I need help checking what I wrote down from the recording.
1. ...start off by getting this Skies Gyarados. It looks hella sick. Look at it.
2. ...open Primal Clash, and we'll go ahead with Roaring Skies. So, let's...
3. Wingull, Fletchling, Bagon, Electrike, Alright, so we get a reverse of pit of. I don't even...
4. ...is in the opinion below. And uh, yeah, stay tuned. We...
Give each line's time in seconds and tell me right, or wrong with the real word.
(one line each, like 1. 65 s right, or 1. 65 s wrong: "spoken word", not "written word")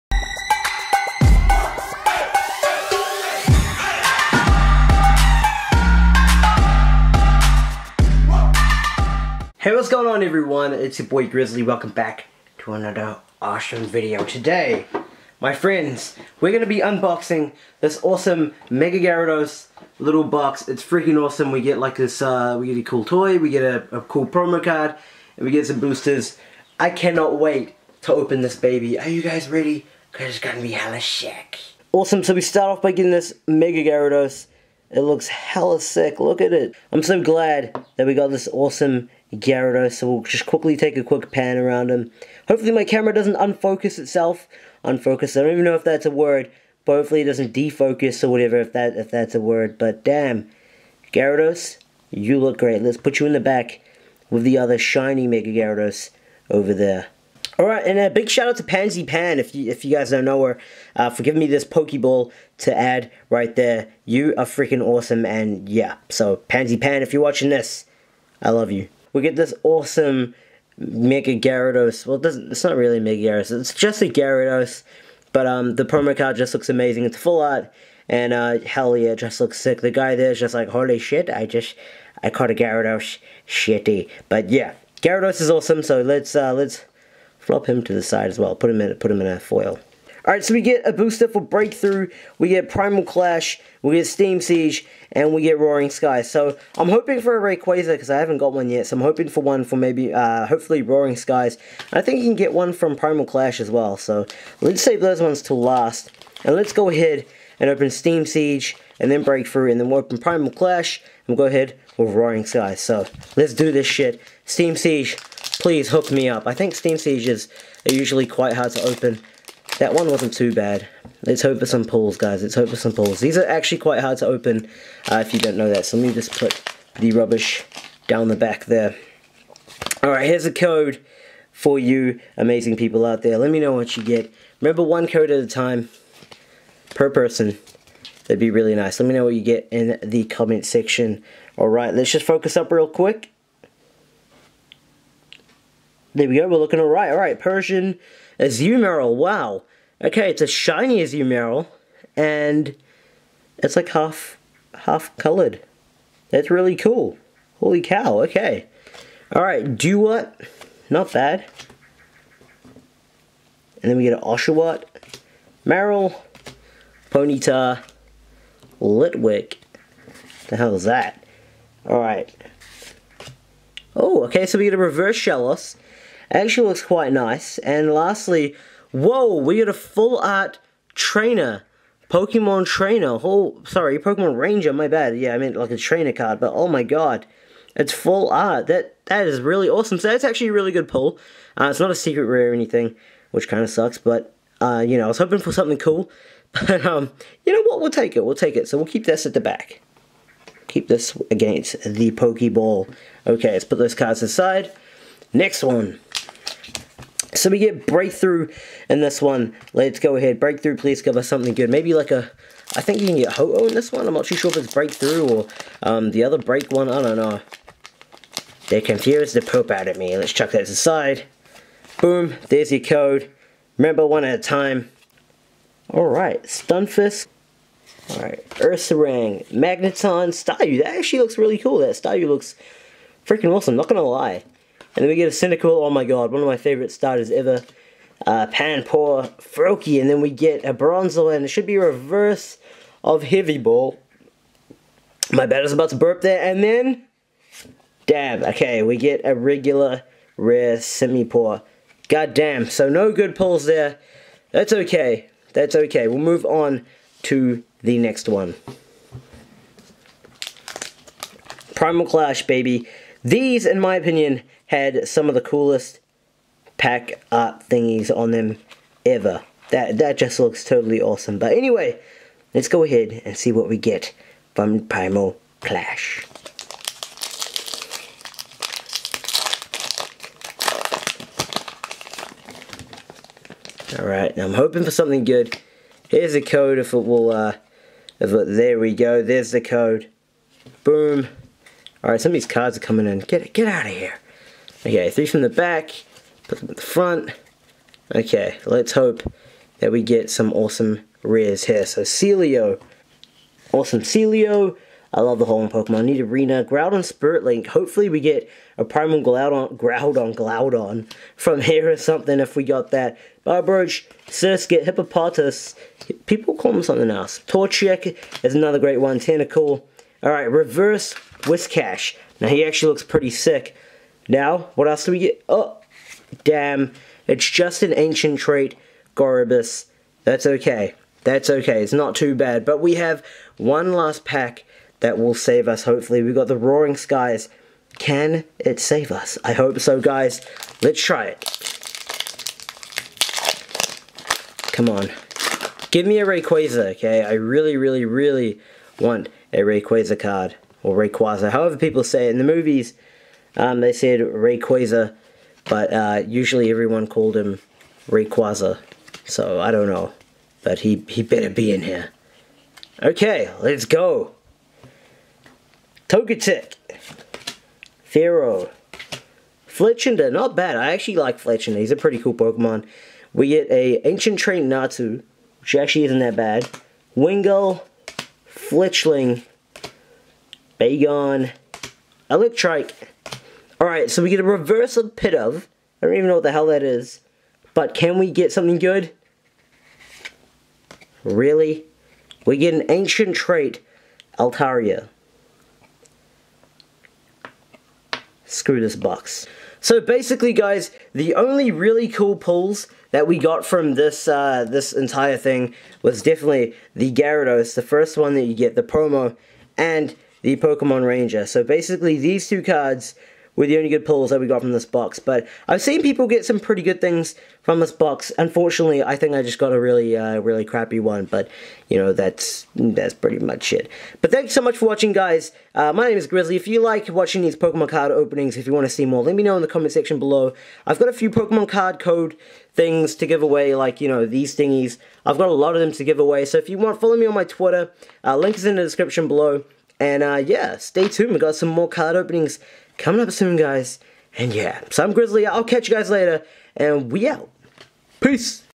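1. 32 s wrong: "Mega", not "Skies"
2. 109 s right
3. 377 s right
4. 438 s wrong: "description", not "opinion".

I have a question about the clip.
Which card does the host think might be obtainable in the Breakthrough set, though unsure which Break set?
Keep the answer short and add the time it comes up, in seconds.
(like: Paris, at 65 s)
Ho-Oh, at 213 s.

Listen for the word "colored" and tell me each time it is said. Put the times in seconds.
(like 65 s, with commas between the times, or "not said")
155 s.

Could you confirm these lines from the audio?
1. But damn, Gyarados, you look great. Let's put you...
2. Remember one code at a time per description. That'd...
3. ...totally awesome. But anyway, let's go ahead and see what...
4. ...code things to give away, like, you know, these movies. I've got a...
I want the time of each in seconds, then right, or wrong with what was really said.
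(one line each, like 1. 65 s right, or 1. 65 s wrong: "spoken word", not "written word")
1. 49 s right
2. 134 s wrong: "person", not "description"
3. 270 s right
4. 431 s wrong: "thingies", not "movies".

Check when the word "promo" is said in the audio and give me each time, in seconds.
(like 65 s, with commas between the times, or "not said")
24 s, 75 s, 408 s.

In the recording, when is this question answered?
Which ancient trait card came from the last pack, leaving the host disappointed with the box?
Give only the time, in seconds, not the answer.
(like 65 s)
394 s.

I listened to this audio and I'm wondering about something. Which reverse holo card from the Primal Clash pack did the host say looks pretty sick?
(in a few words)
Whiscash.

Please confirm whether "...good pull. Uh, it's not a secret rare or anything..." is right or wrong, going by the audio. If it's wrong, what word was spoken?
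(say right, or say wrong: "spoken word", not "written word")
right.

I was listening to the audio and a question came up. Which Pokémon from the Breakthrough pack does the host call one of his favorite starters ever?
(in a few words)
Cyndaquil.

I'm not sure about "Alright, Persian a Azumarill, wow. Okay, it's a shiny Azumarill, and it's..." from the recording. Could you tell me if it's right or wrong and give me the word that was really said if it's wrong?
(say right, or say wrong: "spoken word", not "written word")
right.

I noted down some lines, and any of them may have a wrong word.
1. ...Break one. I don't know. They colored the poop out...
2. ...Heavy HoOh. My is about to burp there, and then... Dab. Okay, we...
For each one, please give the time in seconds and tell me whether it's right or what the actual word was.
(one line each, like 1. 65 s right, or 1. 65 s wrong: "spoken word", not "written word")
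1. 216 s wrong: "confused", not "colored"
2. 243 s wrong: "Ball", not "HoOh".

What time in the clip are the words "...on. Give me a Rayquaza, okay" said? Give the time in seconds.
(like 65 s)
344 s.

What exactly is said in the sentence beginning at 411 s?
So basically, these two cards were the only good pulls that we got from this box.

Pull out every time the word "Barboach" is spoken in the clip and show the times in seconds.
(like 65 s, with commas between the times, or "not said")
313 s.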